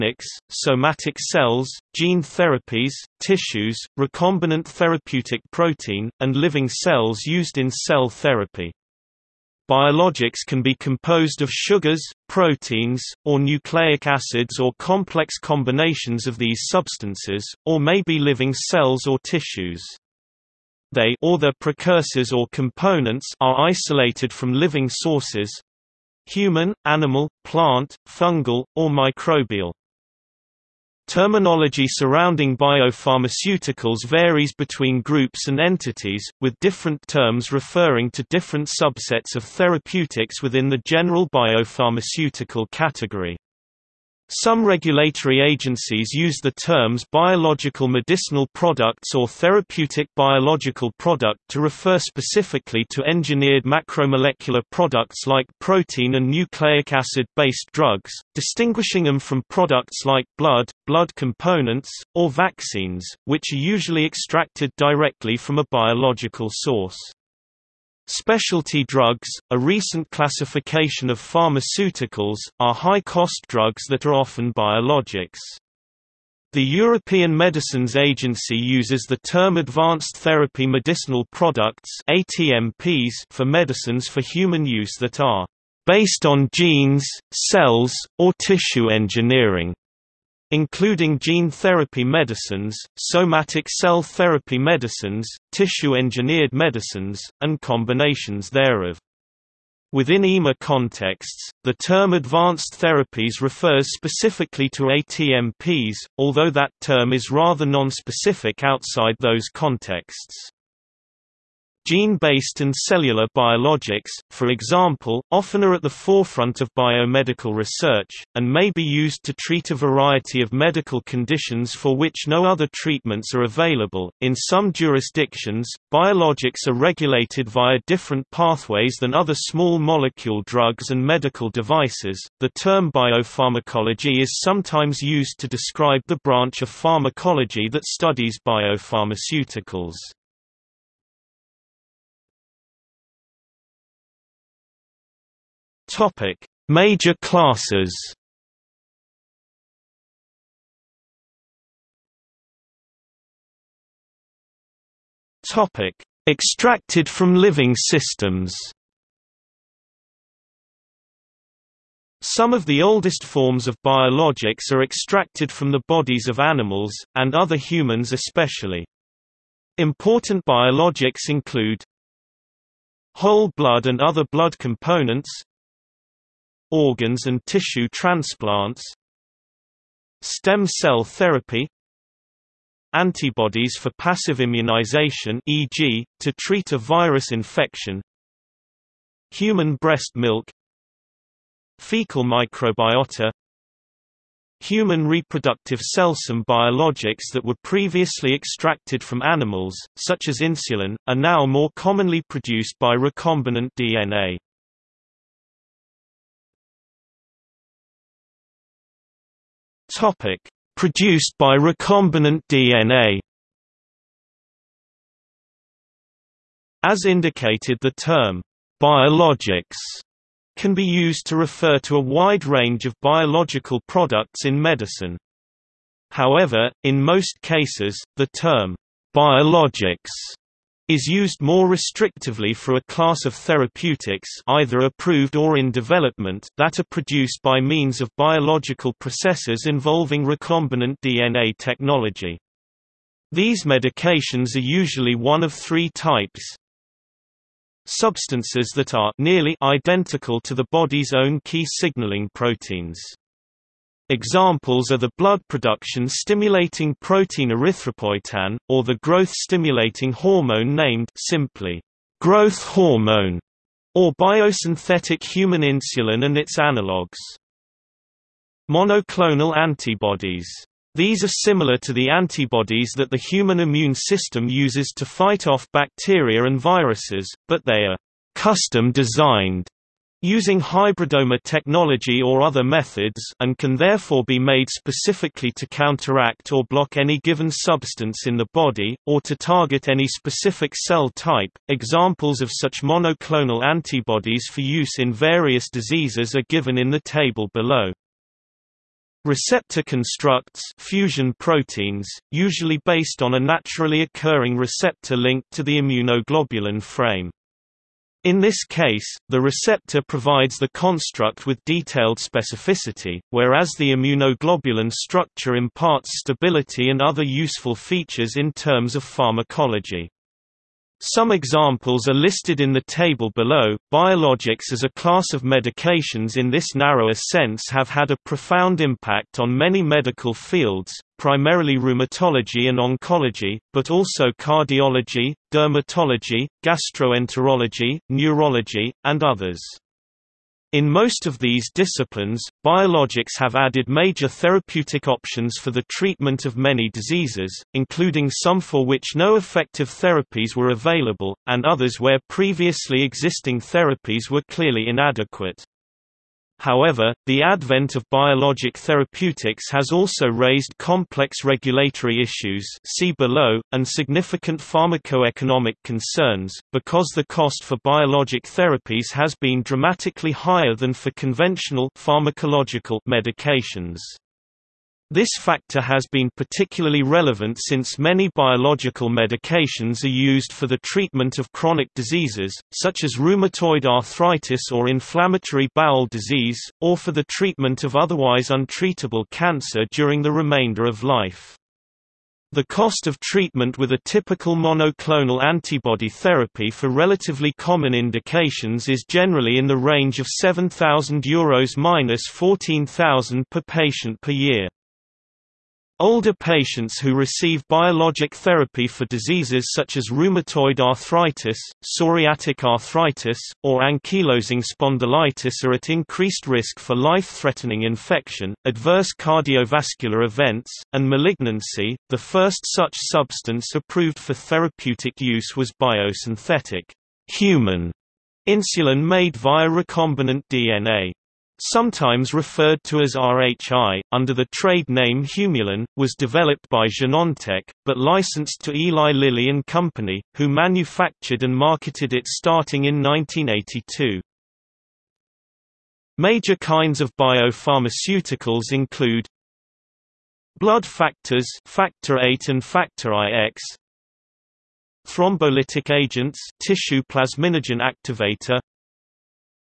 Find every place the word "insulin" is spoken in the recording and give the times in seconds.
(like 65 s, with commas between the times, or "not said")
200 s, 265 s, 428 s.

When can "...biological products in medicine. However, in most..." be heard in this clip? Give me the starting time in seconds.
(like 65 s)
223 s.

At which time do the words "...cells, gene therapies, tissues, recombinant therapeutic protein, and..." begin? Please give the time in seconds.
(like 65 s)
1 s.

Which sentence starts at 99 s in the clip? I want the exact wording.
Within EMA contexts, the term advanced therapies refers specifically to ATMPs, although that term is rather nonspecific outside those contexts.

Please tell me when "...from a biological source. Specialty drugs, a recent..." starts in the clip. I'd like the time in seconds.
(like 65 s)
65 s.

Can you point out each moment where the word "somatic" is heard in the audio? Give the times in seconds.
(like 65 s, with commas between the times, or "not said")
0 s, 92 s.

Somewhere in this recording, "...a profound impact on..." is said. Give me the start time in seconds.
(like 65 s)
328 s.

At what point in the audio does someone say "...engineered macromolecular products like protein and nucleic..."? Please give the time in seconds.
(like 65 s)
53 s.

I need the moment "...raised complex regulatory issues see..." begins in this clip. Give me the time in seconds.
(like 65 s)
360 s.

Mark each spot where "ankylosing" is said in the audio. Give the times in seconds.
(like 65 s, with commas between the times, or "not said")
413 s.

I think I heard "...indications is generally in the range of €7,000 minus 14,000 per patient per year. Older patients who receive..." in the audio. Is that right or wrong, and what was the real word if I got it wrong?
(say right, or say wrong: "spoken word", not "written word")
right.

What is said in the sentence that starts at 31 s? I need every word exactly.
Terminology surrounding biopharmaceuticals varies between groups and entities, with different terms referring to different subsets of therapeutics within the general biopharmaceutical category.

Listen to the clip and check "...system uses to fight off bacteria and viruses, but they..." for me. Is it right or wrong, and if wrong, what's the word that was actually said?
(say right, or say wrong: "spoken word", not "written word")
right.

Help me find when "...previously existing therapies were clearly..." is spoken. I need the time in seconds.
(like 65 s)
352 s.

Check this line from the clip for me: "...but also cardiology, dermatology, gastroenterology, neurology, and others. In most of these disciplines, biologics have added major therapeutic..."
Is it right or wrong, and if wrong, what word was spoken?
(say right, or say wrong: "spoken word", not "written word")
right.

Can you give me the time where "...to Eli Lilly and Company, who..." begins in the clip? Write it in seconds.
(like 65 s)
438 s.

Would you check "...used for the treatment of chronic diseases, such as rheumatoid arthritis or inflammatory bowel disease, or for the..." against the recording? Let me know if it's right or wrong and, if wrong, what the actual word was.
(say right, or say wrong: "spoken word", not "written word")
right.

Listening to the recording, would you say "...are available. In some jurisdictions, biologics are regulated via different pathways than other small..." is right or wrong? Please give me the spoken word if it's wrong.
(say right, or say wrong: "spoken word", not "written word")
right.